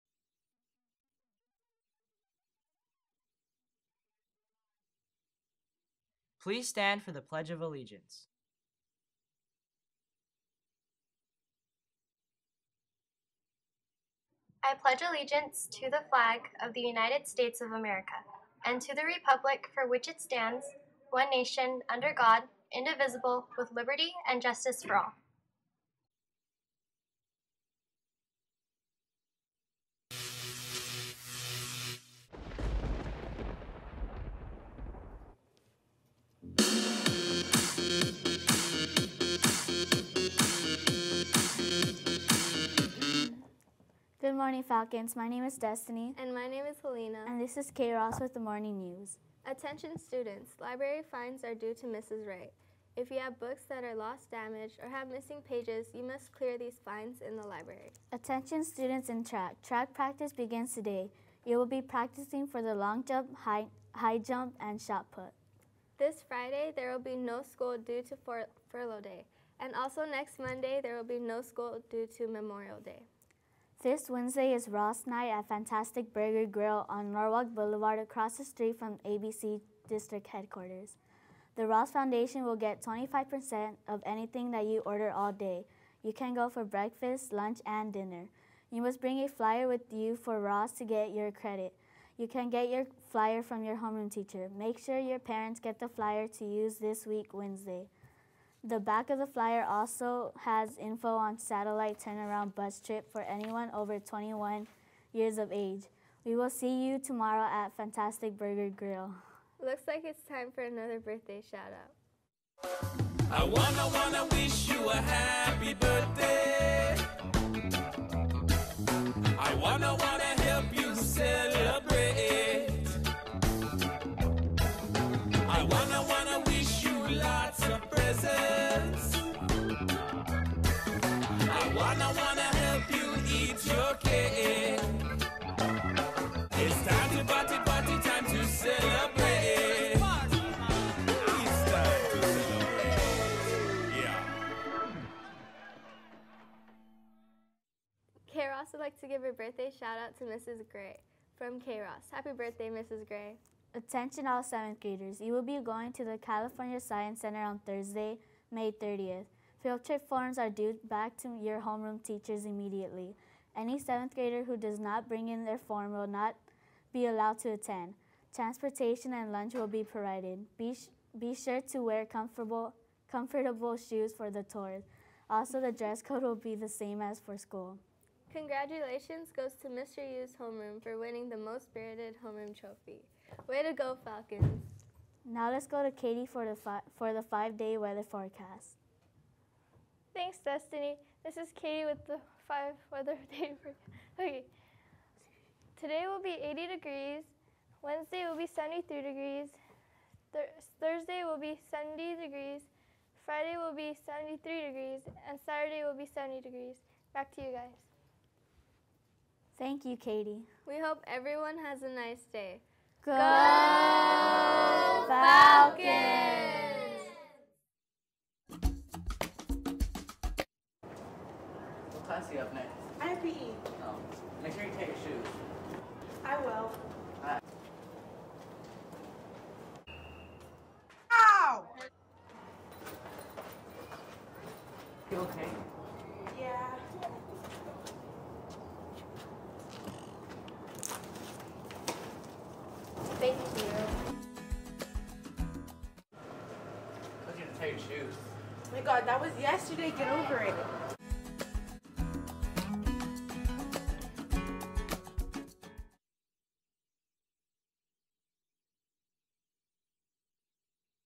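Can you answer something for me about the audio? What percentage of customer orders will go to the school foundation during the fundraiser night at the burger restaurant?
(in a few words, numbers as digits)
25%.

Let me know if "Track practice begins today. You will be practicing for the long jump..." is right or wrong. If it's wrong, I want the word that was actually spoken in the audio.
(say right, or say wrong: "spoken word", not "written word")
right.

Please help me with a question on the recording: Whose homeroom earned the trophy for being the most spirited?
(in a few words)
Mr. Yu's.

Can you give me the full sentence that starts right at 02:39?
Field trip forms are due back to your homeroom teachers immediately.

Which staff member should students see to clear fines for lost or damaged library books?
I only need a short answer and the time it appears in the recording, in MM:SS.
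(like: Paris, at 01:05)
Mrs. Wright, at 00:51.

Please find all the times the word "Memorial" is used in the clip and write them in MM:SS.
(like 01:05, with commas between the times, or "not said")
01:12.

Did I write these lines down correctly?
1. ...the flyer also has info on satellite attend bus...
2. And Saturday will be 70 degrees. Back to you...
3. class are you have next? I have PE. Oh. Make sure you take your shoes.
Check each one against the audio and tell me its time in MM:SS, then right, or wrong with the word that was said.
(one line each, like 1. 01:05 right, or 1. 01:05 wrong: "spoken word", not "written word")
1. 01:39 wrong: "turnaround", not "attend"
2. 03:25 right
3. 03:42 right.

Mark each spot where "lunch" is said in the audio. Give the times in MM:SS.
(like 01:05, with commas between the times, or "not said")
01:27, 02:49.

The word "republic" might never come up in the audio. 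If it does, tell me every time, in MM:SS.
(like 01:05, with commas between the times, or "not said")
00:19.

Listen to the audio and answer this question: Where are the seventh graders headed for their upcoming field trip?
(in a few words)
California Science Center.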